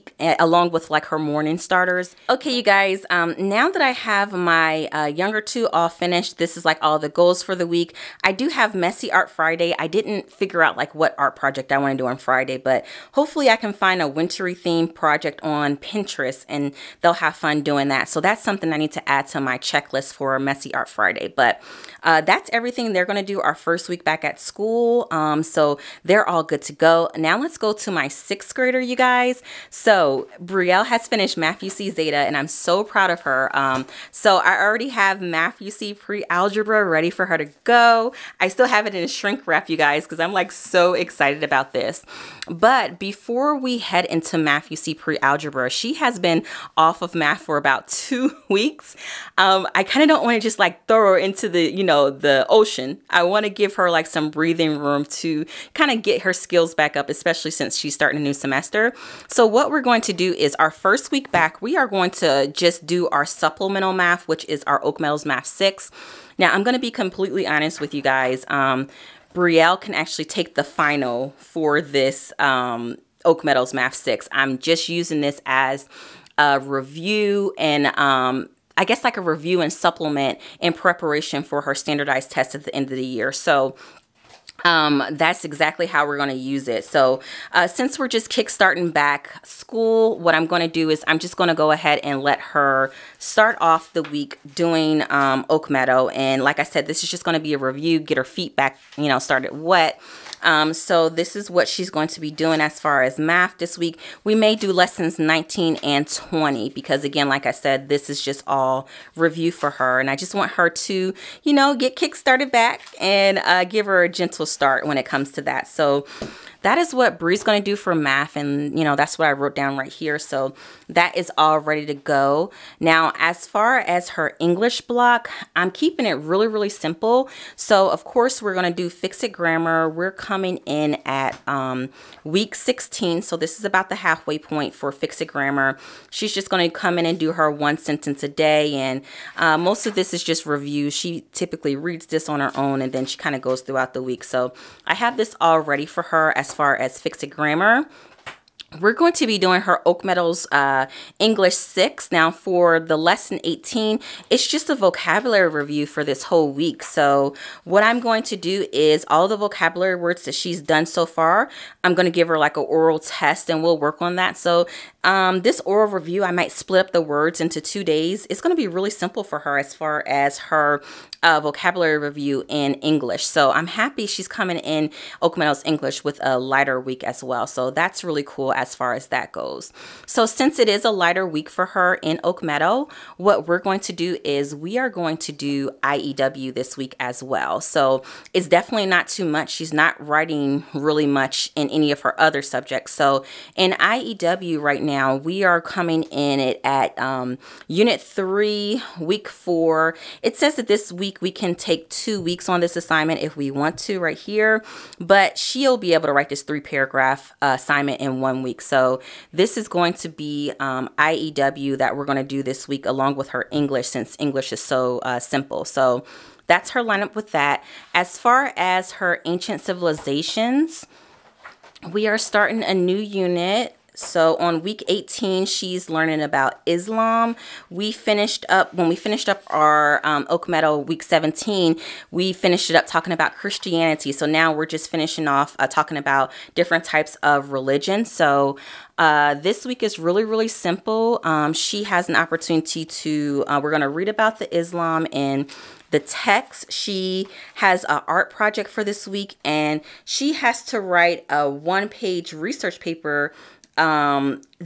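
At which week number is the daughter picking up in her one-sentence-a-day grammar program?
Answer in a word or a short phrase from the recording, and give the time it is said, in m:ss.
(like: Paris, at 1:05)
Week 16, at 2:12.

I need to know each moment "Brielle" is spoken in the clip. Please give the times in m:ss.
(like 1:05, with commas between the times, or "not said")
0:30, 1:09.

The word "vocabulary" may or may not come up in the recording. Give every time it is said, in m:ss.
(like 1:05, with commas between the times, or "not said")
2:34, 2:39, 2:51.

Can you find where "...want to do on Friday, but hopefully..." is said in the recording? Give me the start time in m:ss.
0:11.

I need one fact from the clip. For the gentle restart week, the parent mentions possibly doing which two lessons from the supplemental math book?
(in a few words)
19 and 20.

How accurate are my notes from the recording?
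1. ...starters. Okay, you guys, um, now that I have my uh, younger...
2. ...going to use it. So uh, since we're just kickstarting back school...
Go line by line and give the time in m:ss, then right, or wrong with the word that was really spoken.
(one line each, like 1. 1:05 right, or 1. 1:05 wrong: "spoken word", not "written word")
1. 0:01 right
2. 1:26 right.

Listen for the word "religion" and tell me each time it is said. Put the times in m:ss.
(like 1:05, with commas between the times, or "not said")
3:57.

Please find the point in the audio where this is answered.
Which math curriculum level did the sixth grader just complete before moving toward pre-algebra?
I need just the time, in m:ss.
0:31.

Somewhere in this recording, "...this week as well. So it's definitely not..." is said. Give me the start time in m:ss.
3:06.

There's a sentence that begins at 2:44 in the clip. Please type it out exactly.
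So um, this oral review, I might split up the words into two days.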